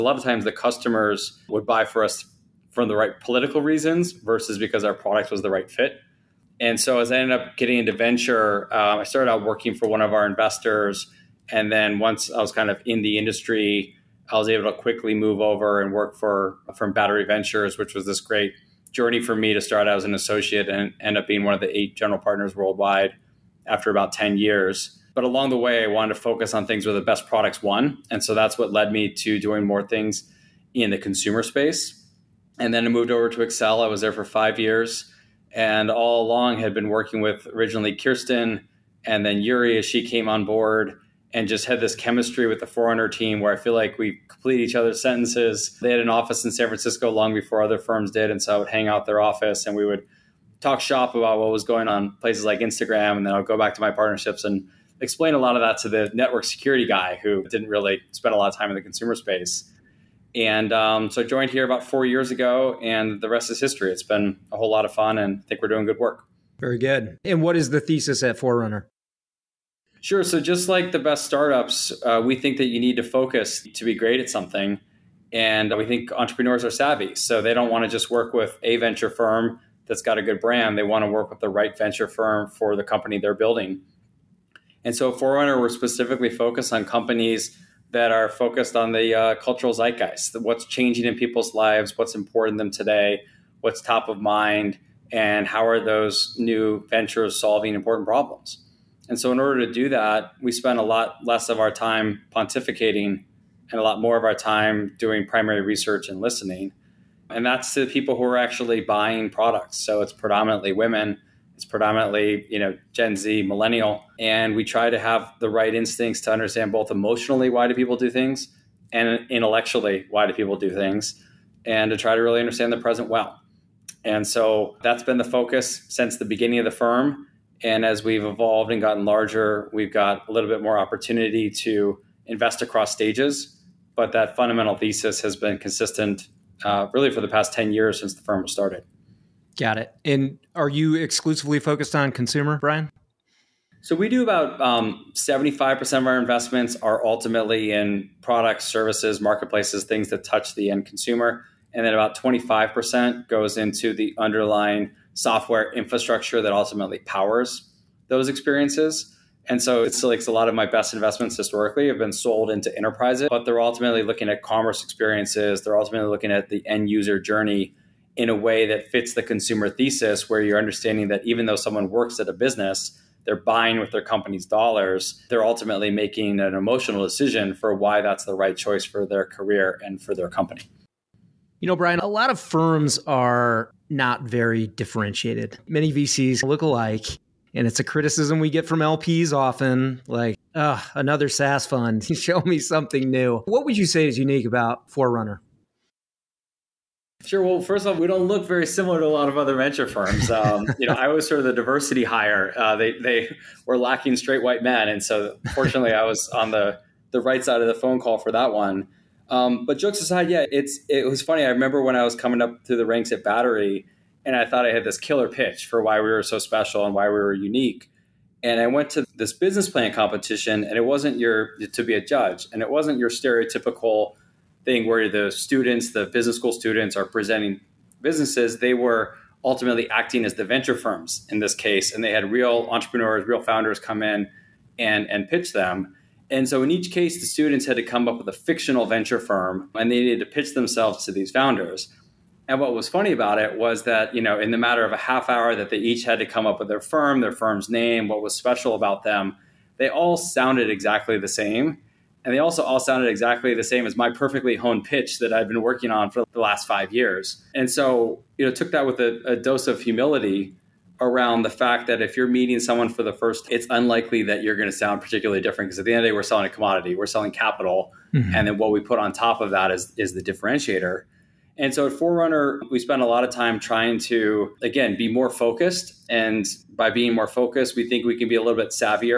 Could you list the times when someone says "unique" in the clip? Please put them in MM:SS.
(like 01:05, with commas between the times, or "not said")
03:14, 03:37.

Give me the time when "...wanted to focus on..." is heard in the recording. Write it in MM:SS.
00:25.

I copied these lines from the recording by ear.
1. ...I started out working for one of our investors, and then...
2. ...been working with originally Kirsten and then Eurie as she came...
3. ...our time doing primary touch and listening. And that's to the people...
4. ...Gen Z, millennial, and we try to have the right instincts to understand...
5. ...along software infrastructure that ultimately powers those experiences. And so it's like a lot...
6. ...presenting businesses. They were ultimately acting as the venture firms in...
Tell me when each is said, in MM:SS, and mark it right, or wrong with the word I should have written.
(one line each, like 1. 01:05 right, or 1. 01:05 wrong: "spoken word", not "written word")
1. 00:08 right
2. 00:36 right
3. 01:44 wrong: "research", not "touch"
4. 01:52 right
5. 02:34 wrong: "underlying", not "along"
6. 03:47 right.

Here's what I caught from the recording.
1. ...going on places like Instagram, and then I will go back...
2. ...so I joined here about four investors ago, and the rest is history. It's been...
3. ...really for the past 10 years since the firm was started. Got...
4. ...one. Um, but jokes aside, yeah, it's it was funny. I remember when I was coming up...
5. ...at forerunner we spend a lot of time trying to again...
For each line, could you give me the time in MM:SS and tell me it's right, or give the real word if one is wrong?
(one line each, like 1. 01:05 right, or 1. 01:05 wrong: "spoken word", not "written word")
1. 00:51 right
2. 01:01 wrong: "years", not "investors"
3. 02:16 right
4. 03:28 right
5. 04:31 right.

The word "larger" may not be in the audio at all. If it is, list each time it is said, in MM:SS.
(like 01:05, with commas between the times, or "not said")
02:09.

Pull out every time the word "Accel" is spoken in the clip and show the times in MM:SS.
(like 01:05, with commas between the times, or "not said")
00:33.